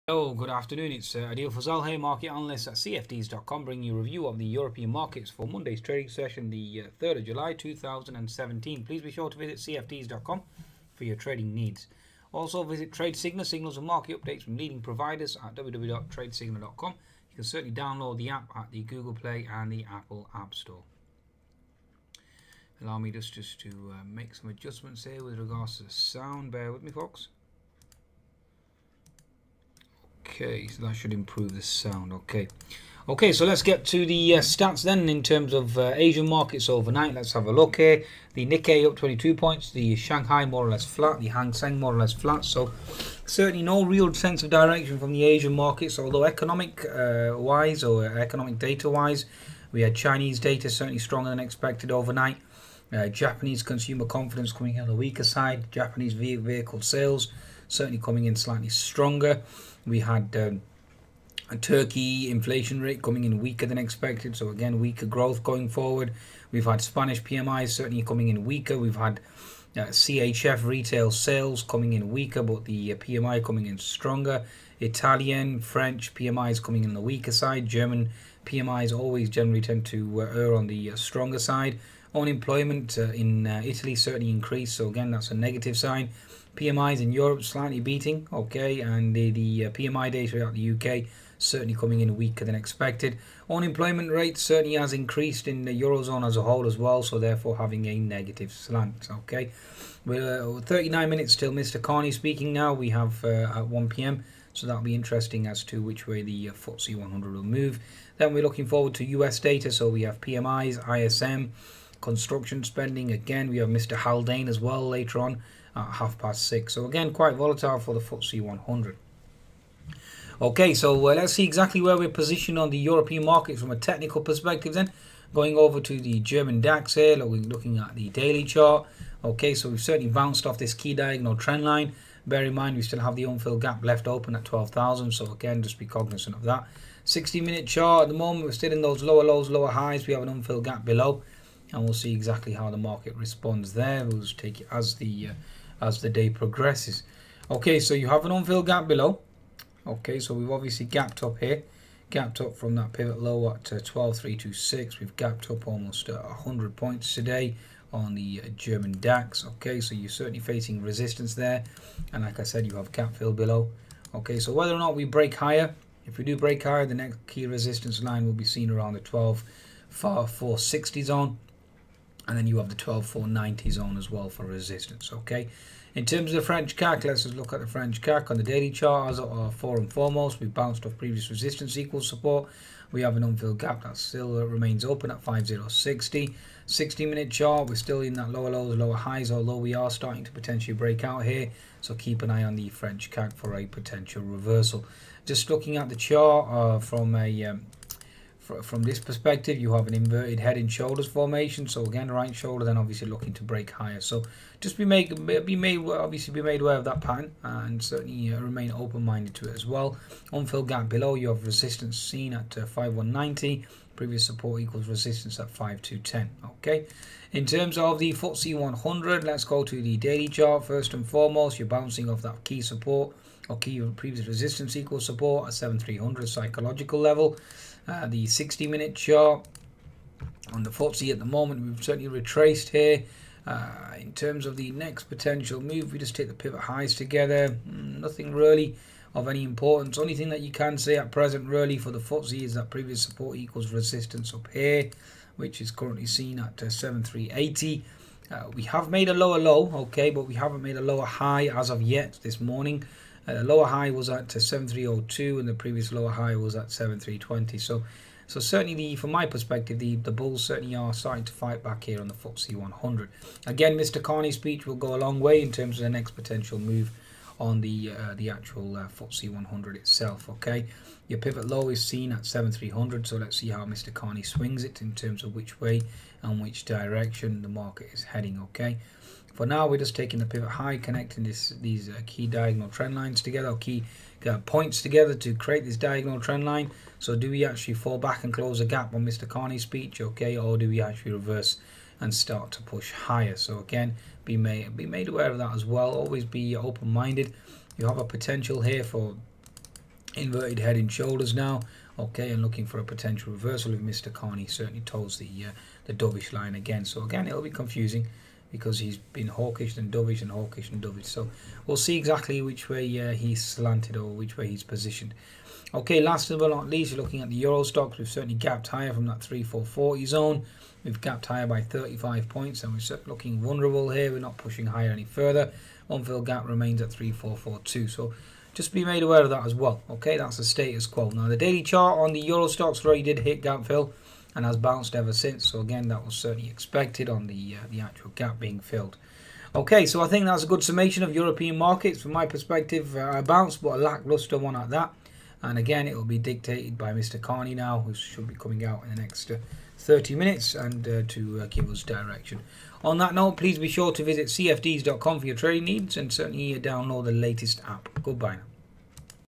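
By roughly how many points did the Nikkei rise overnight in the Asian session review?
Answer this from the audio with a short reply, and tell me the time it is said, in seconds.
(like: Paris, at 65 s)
22 points, at 38 s.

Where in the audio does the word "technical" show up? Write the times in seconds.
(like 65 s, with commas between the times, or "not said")
123 s.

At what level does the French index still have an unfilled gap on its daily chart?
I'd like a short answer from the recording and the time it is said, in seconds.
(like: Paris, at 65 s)
5060, at 185 s.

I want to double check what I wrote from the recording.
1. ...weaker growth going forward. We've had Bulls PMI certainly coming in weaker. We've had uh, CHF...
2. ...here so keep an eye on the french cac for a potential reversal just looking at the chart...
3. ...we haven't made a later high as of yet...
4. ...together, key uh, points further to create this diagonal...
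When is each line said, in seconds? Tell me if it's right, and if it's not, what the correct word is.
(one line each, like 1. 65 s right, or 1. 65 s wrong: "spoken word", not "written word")
1. 64 s wrong: "Spanish", not "Bulls"
2. 191 s right
3. 250 s wrong: "lower", not "later"
4. 283 s wrong: "together", not "further".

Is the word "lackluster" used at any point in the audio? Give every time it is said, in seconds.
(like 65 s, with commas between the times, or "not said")
343 s.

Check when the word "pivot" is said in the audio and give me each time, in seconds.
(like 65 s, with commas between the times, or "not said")
152 s, 236 s, 271 s, 280 s.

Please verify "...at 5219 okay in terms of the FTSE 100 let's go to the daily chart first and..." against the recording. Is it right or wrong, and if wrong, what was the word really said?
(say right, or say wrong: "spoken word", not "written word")
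wrong: "5210", not "5219".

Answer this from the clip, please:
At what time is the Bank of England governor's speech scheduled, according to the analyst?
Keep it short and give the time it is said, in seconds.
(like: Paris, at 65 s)
1pm, at 103 s.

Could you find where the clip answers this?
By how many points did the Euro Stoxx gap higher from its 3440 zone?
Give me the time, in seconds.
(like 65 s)
321 s.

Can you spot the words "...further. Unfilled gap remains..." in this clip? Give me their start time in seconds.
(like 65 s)
325 s.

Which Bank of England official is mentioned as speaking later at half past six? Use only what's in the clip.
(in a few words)
Haldane.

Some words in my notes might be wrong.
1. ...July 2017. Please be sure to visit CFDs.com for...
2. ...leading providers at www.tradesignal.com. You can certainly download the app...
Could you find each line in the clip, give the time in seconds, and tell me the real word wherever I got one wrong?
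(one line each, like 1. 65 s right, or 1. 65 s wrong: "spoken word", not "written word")
1. 7 s right
2. 14 s right.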